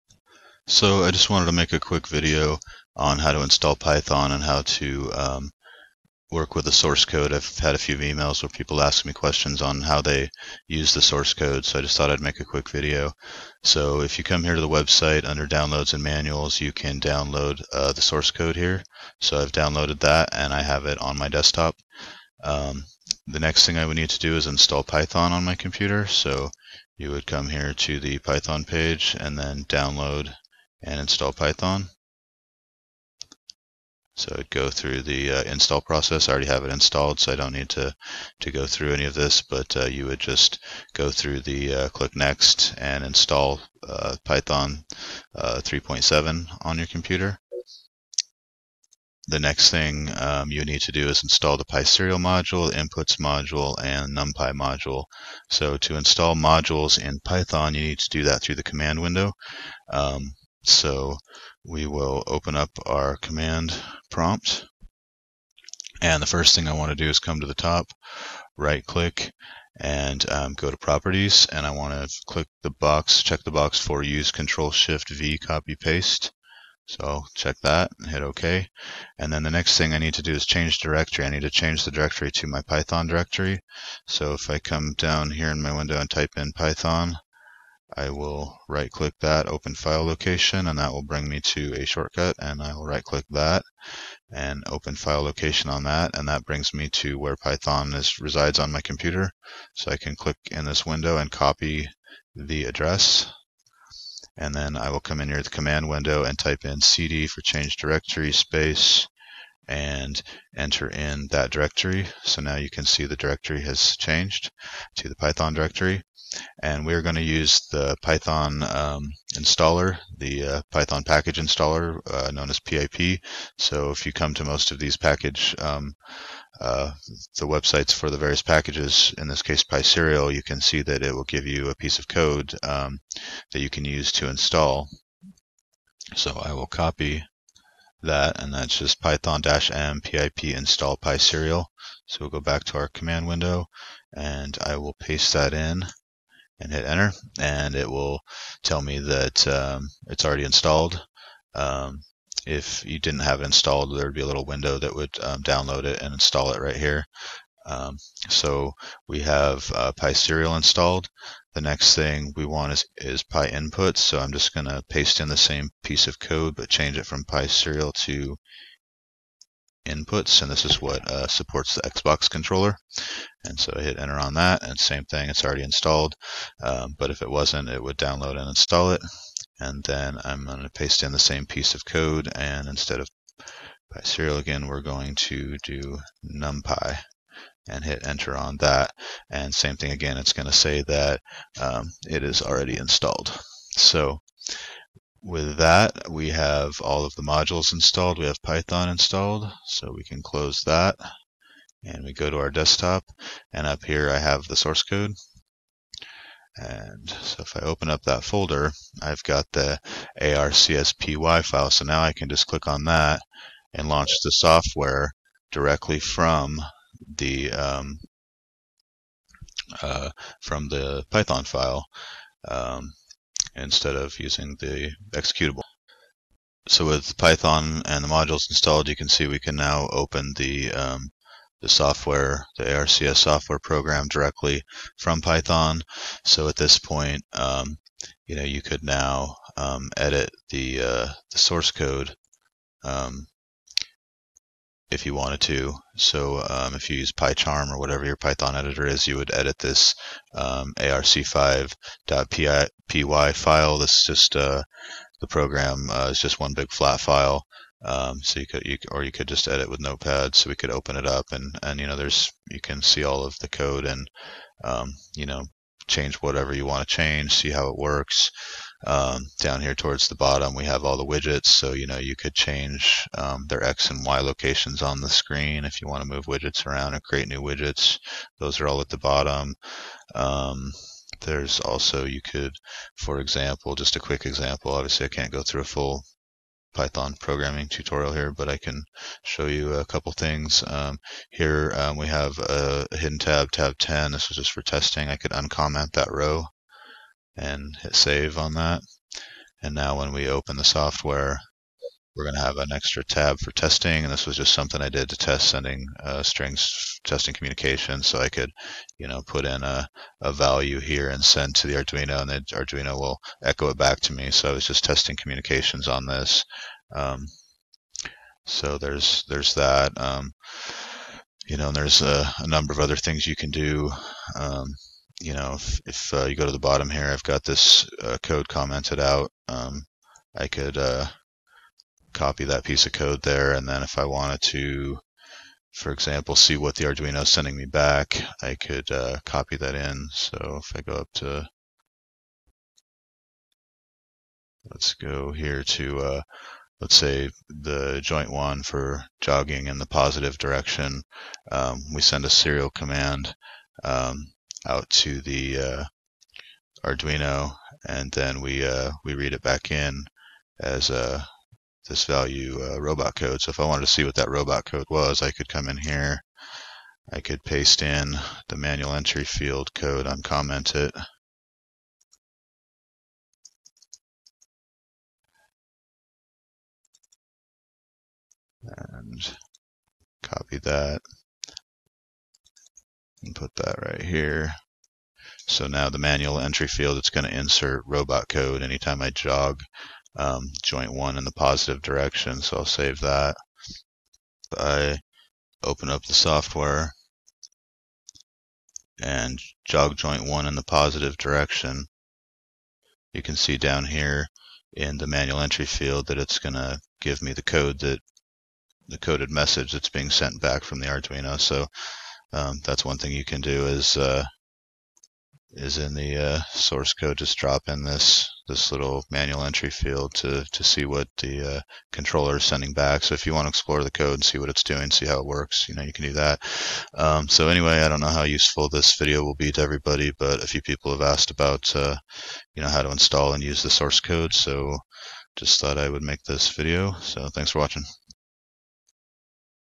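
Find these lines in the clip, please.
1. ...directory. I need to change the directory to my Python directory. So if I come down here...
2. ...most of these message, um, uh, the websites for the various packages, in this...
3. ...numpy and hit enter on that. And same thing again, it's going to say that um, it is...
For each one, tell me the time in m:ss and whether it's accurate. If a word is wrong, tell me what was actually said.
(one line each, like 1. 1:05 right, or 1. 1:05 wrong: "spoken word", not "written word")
1. 1:20 right
2. 2:04 wrong: "package", not "message"
3. 3:06 right.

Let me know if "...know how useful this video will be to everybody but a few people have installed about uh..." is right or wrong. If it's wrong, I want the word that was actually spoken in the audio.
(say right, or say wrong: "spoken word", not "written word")
wrong: "asked", not "installed".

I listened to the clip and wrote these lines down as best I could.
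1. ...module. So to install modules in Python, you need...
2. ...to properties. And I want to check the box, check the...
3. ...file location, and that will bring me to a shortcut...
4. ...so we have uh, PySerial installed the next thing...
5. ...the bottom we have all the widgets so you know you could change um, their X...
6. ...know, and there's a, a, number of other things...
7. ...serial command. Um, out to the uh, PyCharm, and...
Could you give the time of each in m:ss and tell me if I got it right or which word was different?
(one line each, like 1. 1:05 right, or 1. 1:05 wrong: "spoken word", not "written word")
1. 0:54 right
2. 1:10 wrong: "click", not "check"
3. 1:29 right
4. 2:38 right
5. 4:30 right
6. 5:21 right
7. 5:52 wrong: "Arduino", not "PyCharm".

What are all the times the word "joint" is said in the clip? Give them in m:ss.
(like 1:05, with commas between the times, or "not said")
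5:48, 6:30, 6:39.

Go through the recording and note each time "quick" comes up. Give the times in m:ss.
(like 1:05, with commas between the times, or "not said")
0:01, 0:12, 4:43.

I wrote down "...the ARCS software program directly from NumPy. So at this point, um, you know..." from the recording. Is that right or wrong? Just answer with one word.
wrong.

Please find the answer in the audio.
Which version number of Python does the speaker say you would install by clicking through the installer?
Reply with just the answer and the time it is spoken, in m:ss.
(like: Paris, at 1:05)
3.7, at 0:45.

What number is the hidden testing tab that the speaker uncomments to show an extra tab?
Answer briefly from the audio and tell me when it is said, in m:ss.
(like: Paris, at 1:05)
10, at 4:53.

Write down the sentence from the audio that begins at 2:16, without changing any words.
So I will copy that and that's just python-m pip install PySerial.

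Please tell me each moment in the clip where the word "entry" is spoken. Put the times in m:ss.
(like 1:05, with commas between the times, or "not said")
6:08, 6:26, 6:45, 6:59.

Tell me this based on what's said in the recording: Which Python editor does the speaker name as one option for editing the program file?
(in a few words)
PyCharm.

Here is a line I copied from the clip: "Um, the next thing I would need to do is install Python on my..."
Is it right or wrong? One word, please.
right.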